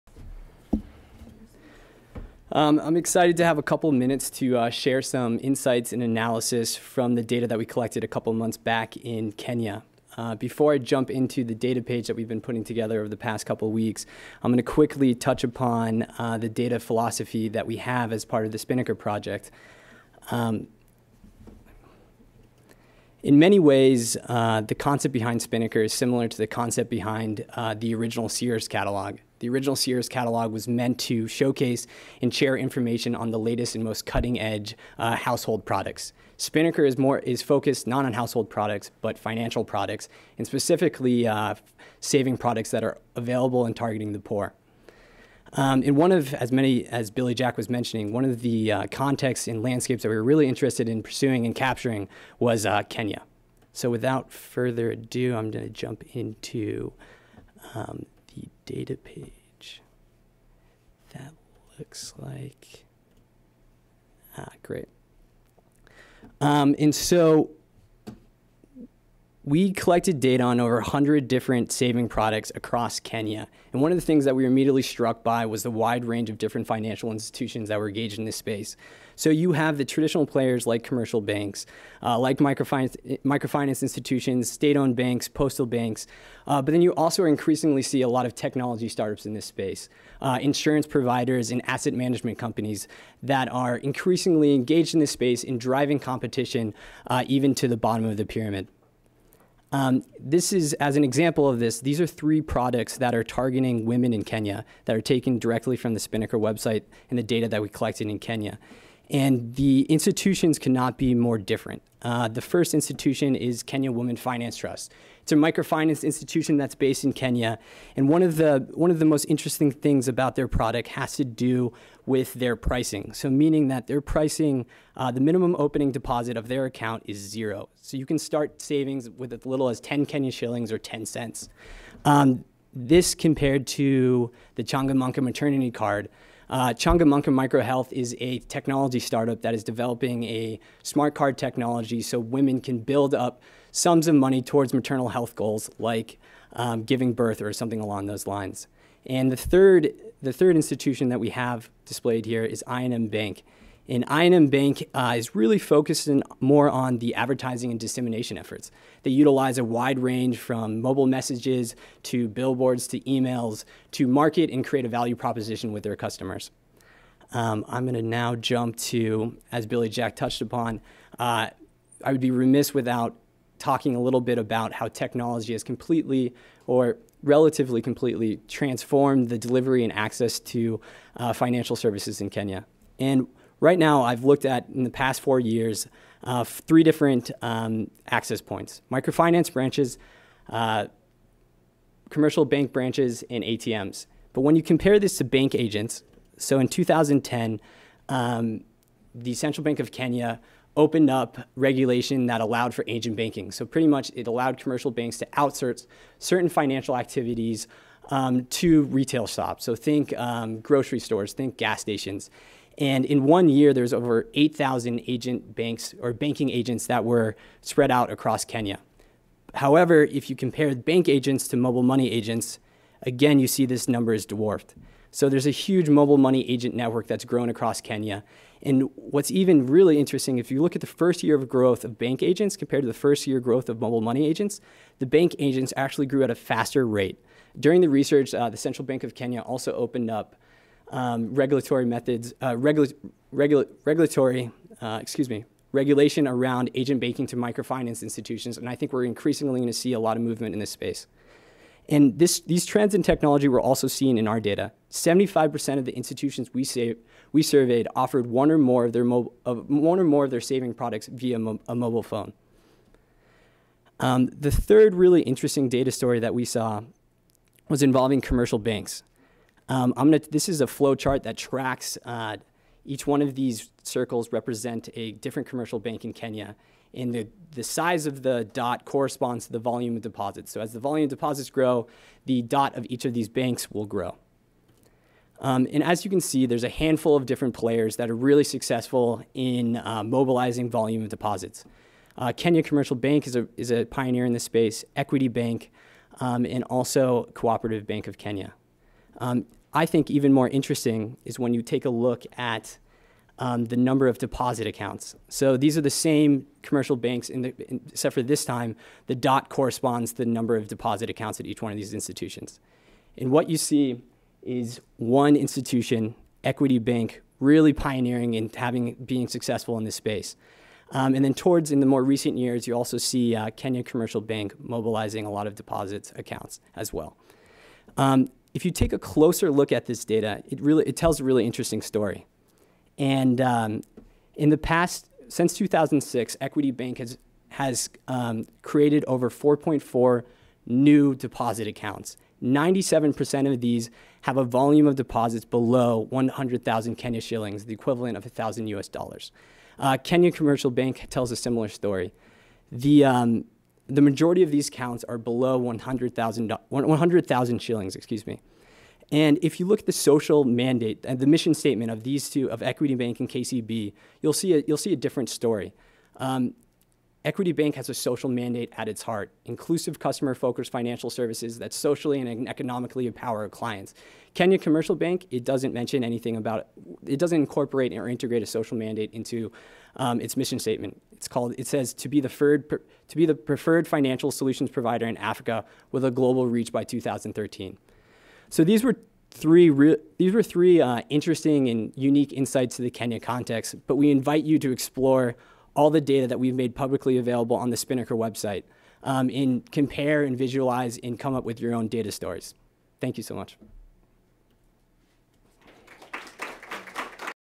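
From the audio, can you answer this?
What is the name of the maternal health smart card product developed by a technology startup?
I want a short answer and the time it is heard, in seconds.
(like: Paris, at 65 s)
Changamka maternity card, at 134 s.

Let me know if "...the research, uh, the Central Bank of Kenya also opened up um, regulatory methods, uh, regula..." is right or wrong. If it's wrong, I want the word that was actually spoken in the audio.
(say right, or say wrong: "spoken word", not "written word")
right.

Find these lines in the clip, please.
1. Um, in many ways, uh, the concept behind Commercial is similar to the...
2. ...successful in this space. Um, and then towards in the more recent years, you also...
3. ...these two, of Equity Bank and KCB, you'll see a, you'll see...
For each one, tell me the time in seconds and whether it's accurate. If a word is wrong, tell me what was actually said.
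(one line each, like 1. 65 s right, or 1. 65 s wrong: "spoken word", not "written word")
1. 20 s wrong: "Spinnaker", not "Commercial"
2. 319 s right
3. 362 s right.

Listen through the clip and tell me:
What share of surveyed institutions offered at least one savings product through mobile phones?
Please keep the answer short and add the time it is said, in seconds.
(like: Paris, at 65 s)
75%, at 254 s.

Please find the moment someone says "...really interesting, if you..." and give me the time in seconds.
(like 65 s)
229 s.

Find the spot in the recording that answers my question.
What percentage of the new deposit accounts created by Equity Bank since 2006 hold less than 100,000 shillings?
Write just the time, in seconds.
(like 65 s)
342 s.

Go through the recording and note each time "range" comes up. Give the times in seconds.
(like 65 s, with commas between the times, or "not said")
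76 s, 159 s.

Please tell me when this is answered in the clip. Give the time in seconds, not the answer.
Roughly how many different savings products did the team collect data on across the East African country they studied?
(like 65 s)
70 s.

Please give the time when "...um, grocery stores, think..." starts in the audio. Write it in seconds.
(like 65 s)
210 s.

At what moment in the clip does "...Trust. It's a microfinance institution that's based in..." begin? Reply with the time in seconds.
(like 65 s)
114 s.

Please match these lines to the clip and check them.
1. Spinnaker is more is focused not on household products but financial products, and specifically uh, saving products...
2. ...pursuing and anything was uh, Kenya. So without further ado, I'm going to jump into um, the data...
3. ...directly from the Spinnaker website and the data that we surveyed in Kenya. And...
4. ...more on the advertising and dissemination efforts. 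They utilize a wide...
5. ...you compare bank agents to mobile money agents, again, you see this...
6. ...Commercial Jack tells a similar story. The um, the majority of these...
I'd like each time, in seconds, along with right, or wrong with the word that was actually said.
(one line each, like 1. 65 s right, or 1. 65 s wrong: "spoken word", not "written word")
1. 36 s right
2. 51 s wrong: "capturing", not "anything"
3. 105 s wrong: "collected", not "surveyed"
4. 156 s right
5. 220 s right
6. 350 s wrong: "Bank", not "Jack".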